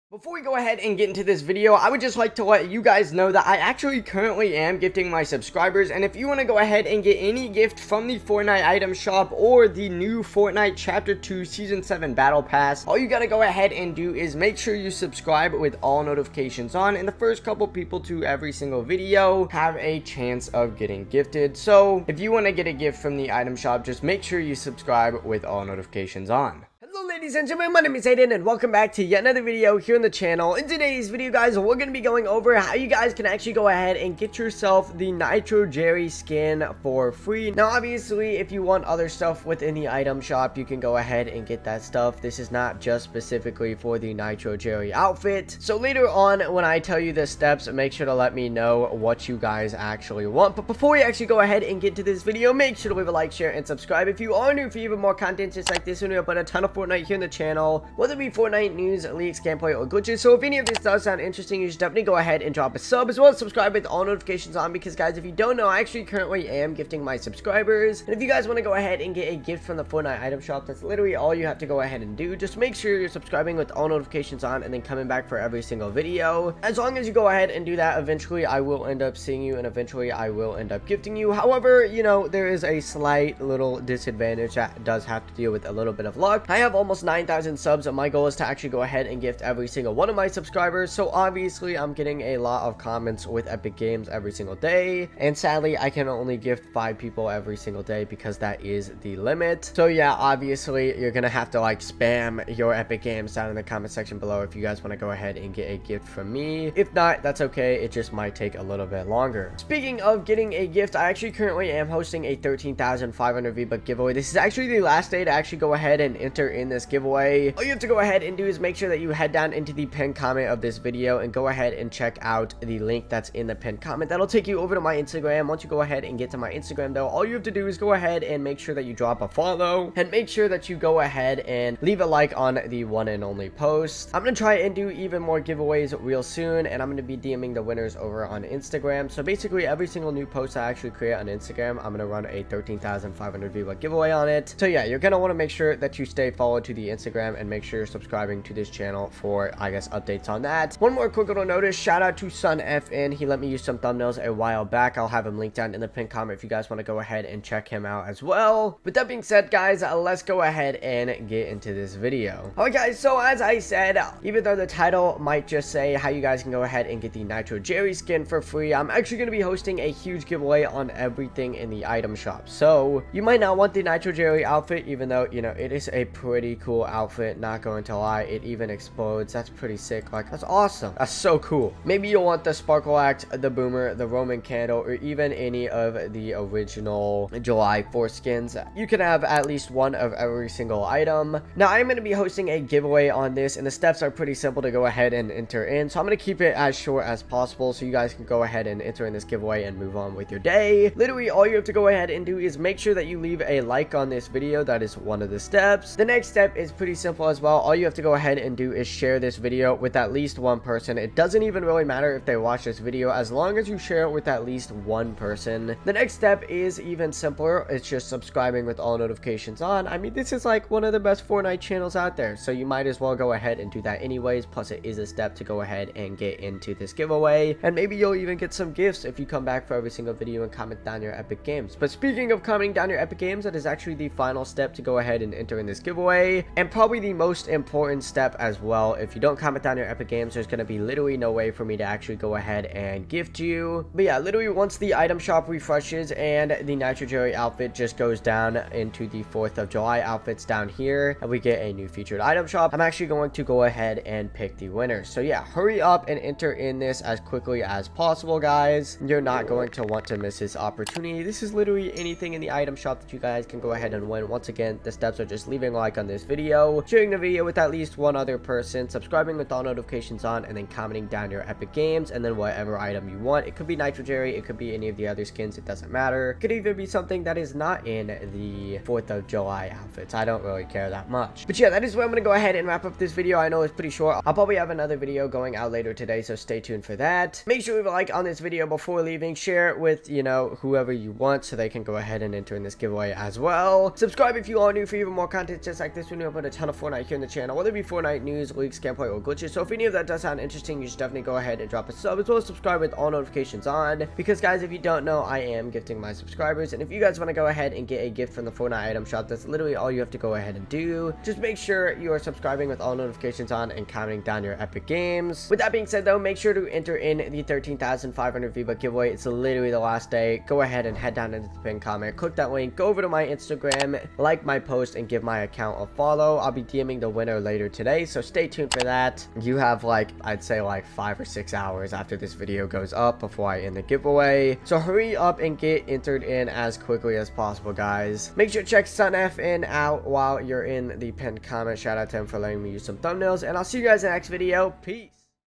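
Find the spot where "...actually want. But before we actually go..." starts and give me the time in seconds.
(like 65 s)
49 s.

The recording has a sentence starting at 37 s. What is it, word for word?
Now obviously, if you want other stuff within the item shop, you can go ahead and get that stuff.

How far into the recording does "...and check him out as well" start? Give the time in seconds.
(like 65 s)
157 s.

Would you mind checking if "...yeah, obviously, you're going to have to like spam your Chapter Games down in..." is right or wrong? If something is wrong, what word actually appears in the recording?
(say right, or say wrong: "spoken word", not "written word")
wrong: "Epic", not "Chapter".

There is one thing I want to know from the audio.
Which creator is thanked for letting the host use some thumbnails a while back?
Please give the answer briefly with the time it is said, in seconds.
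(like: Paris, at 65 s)
Sun FN, at 152 s.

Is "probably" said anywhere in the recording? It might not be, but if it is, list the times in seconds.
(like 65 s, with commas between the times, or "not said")
236 s, 284 s.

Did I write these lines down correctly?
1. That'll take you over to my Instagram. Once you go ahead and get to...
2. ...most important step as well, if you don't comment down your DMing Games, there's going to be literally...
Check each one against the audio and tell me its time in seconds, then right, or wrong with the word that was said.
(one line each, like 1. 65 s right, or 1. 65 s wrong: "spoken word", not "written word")
1. 124 s right
2. 237 s wrong: "Epic", not "DMing".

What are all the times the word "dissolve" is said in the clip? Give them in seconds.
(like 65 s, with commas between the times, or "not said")
not said.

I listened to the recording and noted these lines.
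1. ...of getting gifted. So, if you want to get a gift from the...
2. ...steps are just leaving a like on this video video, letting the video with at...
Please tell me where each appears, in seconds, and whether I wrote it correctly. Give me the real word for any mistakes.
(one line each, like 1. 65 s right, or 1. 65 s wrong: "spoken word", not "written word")
1. 20 s right
2. 264 s wrong: "sharing", not "letting".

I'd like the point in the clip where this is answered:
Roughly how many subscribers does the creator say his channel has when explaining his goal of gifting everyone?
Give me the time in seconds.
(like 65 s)
87 s.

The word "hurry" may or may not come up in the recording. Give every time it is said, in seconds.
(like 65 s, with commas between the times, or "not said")
255 s, 334 s.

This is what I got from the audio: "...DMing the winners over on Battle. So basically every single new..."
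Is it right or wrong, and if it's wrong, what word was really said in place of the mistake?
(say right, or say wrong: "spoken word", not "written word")
wrong: "Instagram", not "Battle".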